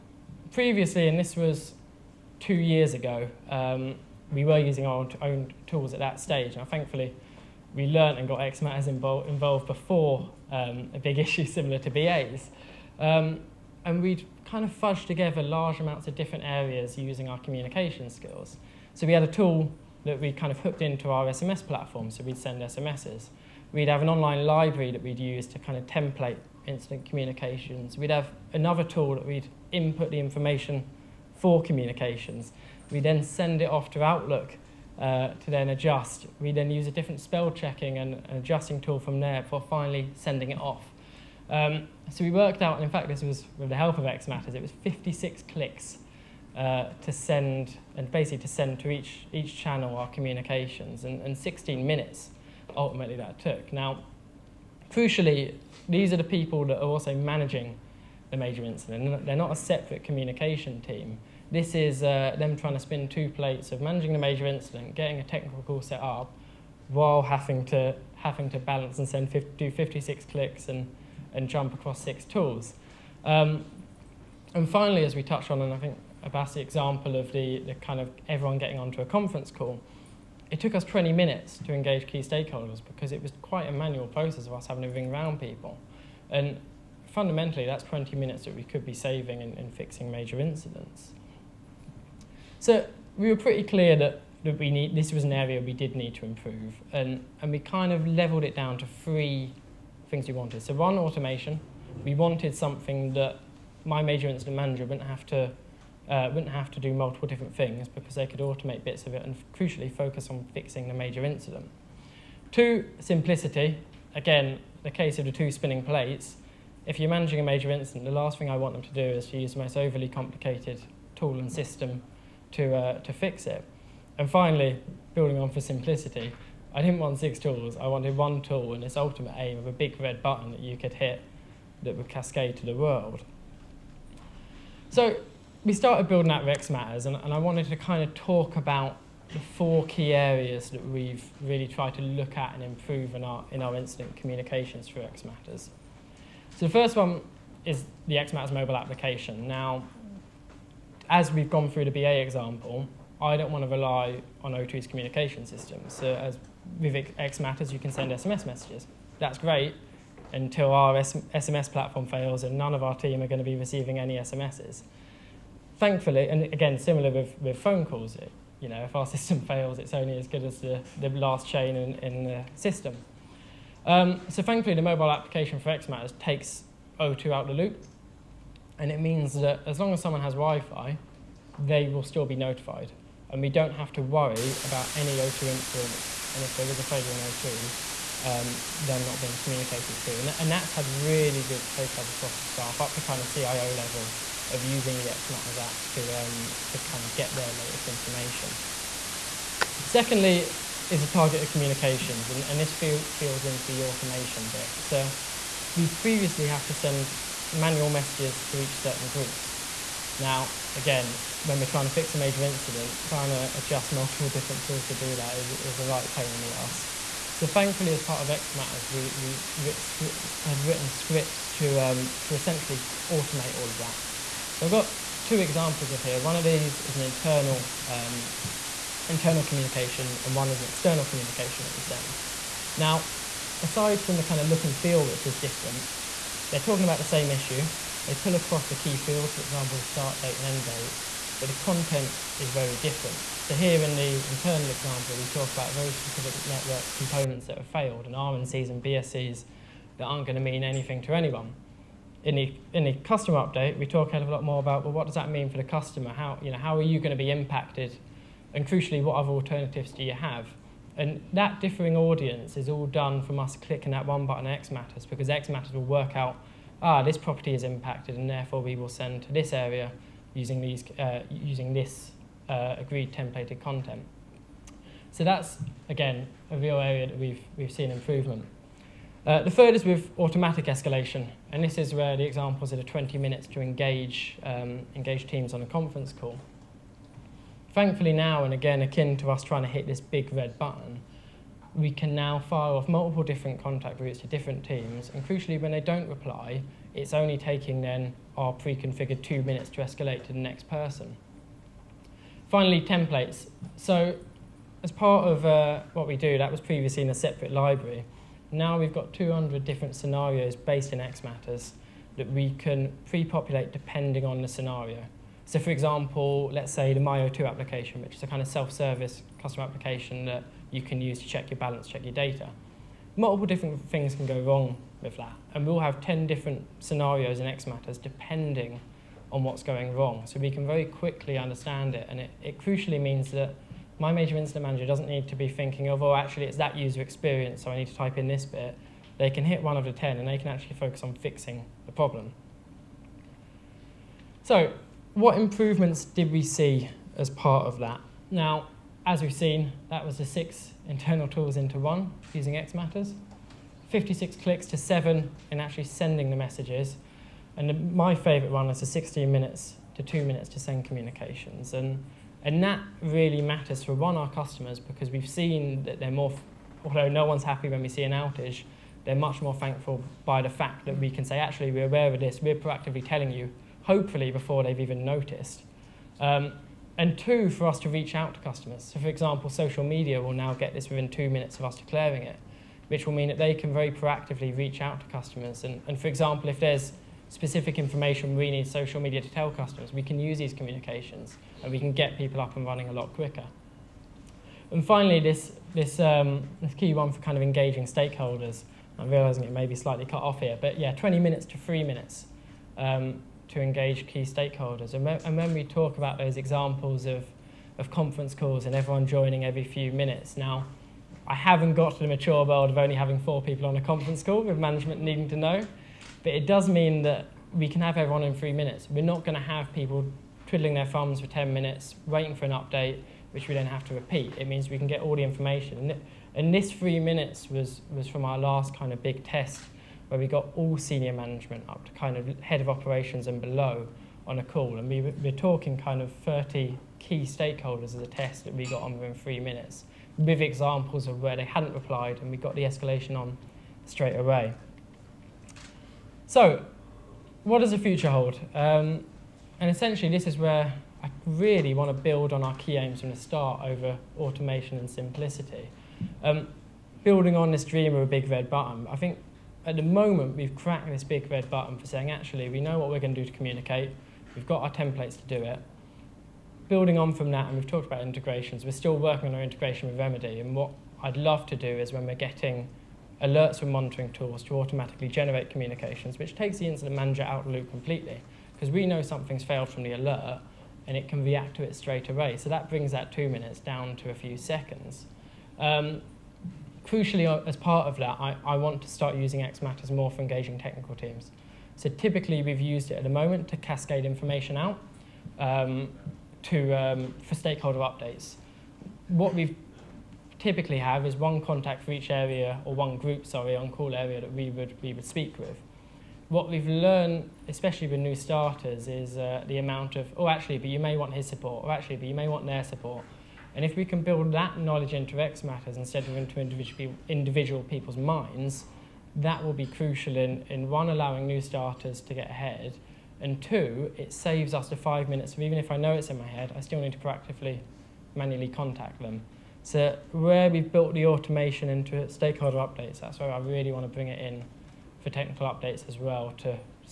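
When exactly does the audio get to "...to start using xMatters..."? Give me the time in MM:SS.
08:08.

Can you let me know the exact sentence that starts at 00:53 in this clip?
Now, crucially, these are the people that are also managing the major incident.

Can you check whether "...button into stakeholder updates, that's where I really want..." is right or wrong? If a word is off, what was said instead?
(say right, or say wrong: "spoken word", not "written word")
wrong: "automation", not "button".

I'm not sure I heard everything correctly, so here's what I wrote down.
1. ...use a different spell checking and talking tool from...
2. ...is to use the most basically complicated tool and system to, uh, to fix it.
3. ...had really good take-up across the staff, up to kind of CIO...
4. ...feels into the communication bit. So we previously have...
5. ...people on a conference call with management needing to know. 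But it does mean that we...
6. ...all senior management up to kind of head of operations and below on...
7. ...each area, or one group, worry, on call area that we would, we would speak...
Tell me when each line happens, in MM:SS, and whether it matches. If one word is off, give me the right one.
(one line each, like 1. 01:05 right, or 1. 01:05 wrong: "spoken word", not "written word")
1. 00:36 wrong: "adjusting", not "talking"
2. 01:59 wrong: "overly", not "basically"
3. 03:10 right
4. 03:22 wrong: "automation", not "communication"
5. 06:53 right
6. 07:10 right
7. 08:21 wrong: "sorry", not "worry".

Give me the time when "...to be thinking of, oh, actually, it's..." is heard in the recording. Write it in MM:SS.
05:35.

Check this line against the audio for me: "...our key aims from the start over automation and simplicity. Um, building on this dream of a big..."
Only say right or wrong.
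right.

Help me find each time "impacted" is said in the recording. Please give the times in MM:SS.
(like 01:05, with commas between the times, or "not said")
04:17, 04:27.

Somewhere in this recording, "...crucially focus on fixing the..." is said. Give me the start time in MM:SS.
01:49.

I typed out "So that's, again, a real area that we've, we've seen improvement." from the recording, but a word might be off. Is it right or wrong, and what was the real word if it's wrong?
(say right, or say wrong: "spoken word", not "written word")
right.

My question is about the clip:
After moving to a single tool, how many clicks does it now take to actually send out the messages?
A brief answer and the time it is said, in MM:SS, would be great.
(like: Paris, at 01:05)
7, at 05:54.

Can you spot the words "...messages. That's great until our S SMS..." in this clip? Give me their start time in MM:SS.
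02:38.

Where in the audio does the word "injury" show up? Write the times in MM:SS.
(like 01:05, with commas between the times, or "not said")
not said.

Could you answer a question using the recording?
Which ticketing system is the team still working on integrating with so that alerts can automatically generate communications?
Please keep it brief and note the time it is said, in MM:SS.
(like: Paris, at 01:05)
Remedy, at 07:49.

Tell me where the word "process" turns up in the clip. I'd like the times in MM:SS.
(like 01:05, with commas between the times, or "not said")
01:24.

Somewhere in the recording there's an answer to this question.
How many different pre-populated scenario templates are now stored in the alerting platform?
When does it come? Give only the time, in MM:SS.
05:09.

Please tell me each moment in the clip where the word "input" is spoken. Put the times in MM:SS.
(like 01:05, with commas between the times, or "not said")
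00:29.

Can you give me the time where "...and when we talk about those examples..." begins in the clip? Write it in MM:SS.
06:45.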